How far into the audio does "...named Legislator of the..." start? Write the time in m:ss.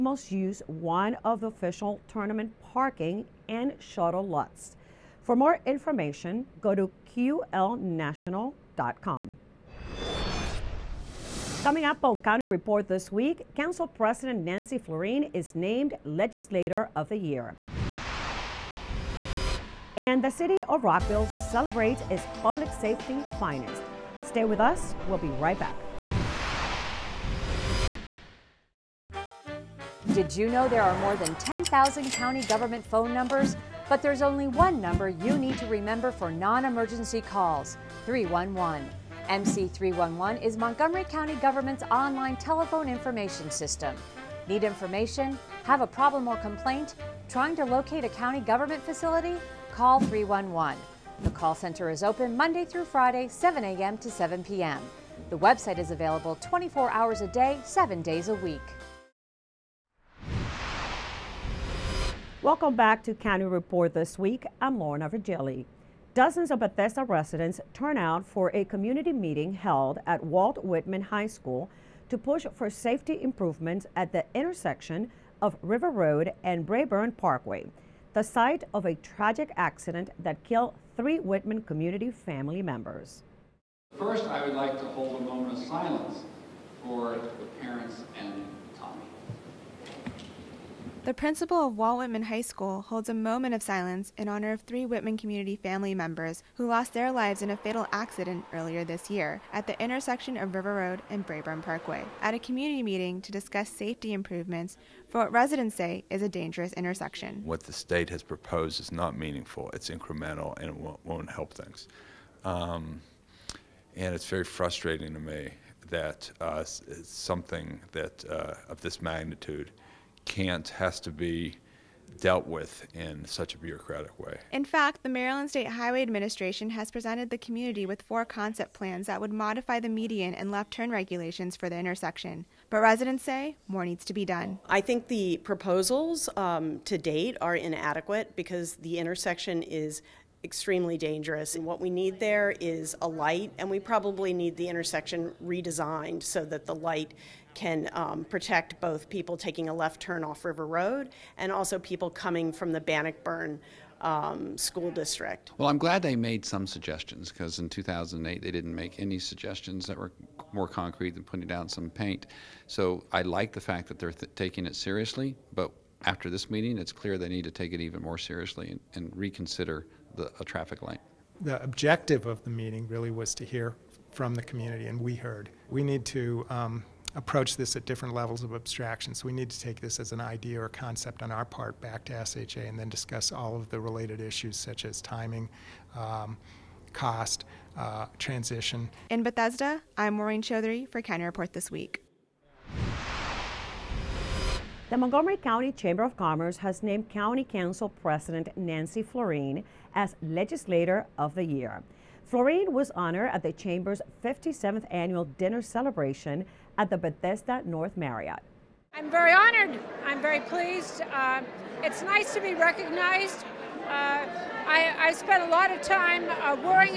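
0:15.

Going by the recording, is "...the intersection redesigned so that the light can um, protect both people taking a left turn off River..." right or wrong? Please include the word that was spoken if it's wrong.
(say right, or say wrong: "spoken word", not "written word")
right.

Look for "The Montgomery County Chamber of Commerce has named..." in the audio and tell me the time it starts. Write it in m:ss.
3:14.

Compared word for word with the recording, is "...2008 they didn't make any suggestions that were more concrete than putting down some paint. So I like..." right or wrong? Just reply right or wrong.
right.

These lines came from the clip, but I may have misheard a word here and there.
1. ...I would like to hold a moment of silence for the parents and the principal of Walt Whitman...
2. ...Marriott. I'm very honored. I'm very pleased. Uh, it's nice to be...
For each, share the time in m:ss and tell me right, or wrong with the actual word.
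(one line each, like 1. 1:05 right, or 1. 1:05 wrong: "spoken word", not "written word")
1. 1:24 right
2. 3:27 right.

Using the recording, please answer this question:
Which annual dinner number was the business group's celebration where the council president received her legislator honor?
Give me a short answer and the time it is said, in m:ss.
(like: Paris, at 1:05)
57th, at 3:24.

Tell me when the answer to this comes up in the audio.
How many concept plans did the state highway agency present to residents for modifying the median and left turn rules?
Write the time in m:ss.
2:08.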